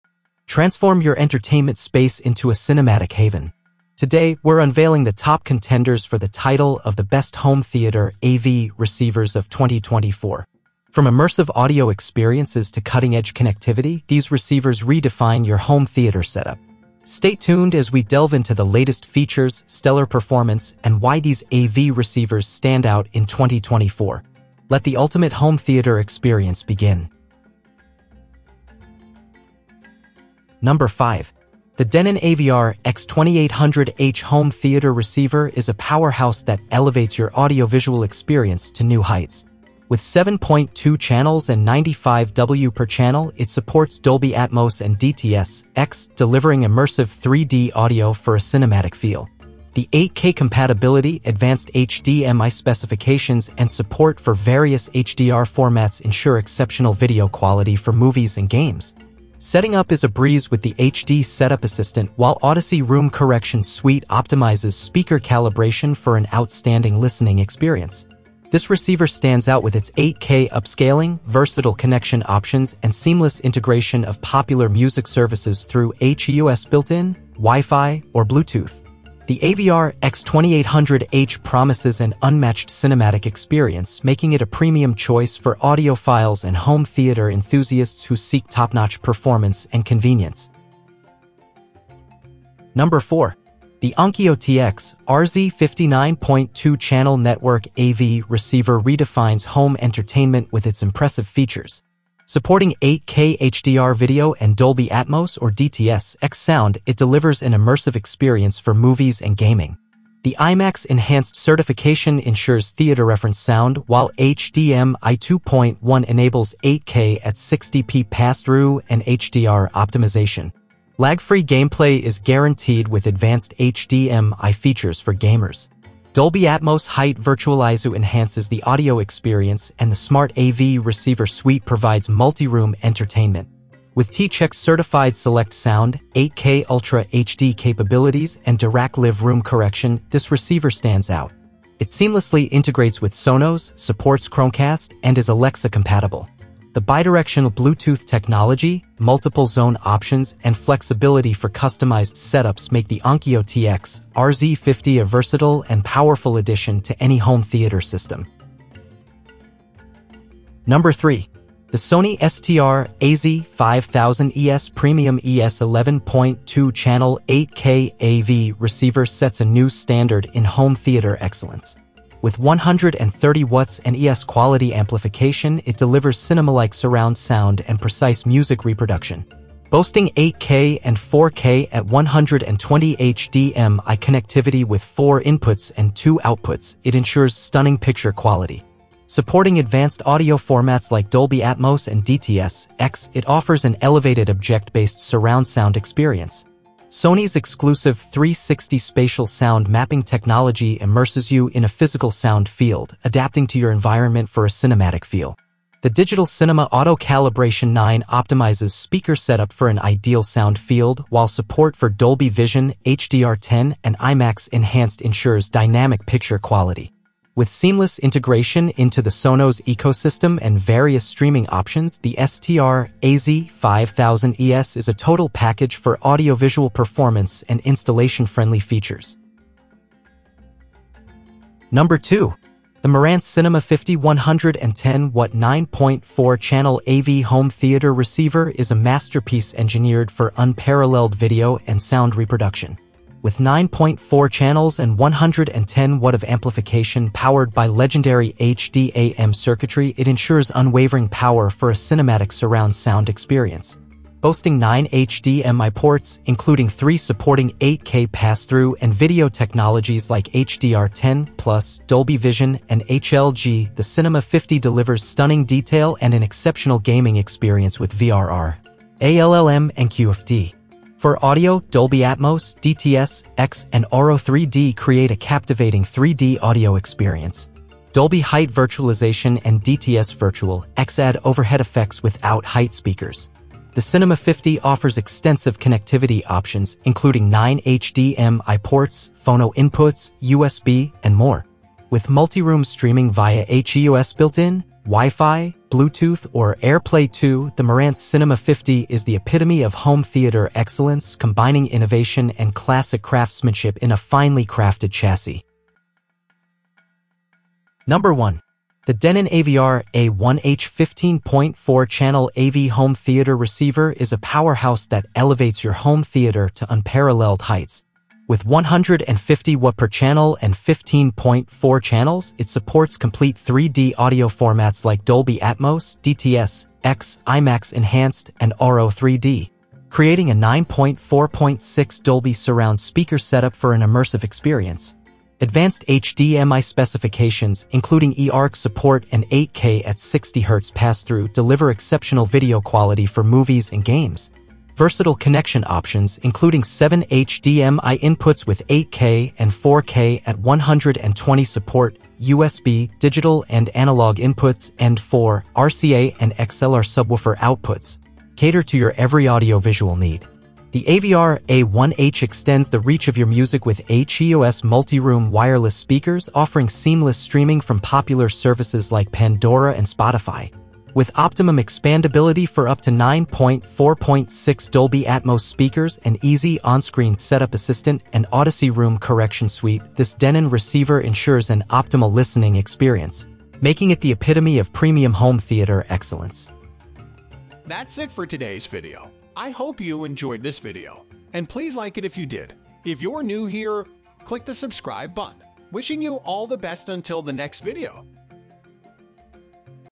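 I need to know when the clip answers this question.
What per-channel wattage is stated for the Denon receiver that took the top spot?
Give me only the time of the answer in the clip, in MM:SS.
05:18.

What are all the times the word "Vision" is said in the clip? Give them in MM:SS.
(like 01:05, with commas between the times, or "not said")
03:32, 04:22.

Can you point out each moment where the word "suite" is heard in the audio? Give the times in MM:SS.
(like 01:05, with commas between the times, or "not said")
01:03, 02:11, 06:19.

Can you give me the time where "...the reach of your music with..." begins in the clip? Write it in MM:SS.
06:02.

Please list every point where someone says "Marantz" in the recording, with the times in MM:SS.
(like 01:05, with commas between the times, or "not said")
03:52, 04:57.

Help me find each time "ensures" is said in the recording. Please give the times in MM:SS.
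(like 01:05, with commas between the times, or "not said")
00:56, 01:52, 03:06, 03:34, 04:10, 06:21.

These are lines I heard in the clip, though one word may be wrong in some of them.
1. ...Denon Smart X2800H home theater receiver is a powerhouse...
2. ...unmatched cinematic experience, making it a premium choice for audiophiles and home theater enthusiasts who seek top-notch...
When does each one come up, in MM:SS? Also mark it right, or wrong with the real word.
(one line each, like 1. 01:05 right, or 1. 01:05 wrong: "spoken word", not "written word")
1. 00:31 wrong: "AVR", not "Smart"
2. 01:22 right.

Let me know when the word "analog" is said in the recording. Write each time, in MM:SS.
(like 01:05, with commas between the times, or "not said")
05:53.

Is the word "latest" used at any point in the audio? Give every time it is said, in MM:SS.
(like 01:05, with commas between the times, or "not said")
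00:18.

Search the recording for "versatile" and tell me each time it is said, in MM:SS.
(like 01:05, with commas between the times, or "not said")
01:11, 02:35, 05:44.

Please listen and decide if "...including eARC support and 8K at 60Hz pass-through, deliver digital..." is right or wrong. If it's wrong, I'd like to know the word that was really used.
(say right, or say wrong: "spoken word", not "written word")
wrong: "exceptional", not "digital".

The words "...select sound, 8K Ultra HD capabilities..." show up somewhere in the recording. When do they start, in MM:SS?
02:15.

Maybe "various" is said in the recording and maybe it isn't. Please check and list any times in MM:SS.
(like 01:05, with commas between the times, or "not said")
00:54, 03:40.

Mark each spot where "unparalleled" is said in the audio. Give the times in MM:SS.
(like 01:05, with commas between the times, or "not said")
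04:00, 05:16.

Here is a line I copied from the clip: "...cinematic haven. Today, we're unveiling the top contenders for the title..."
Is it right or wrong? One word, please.
right.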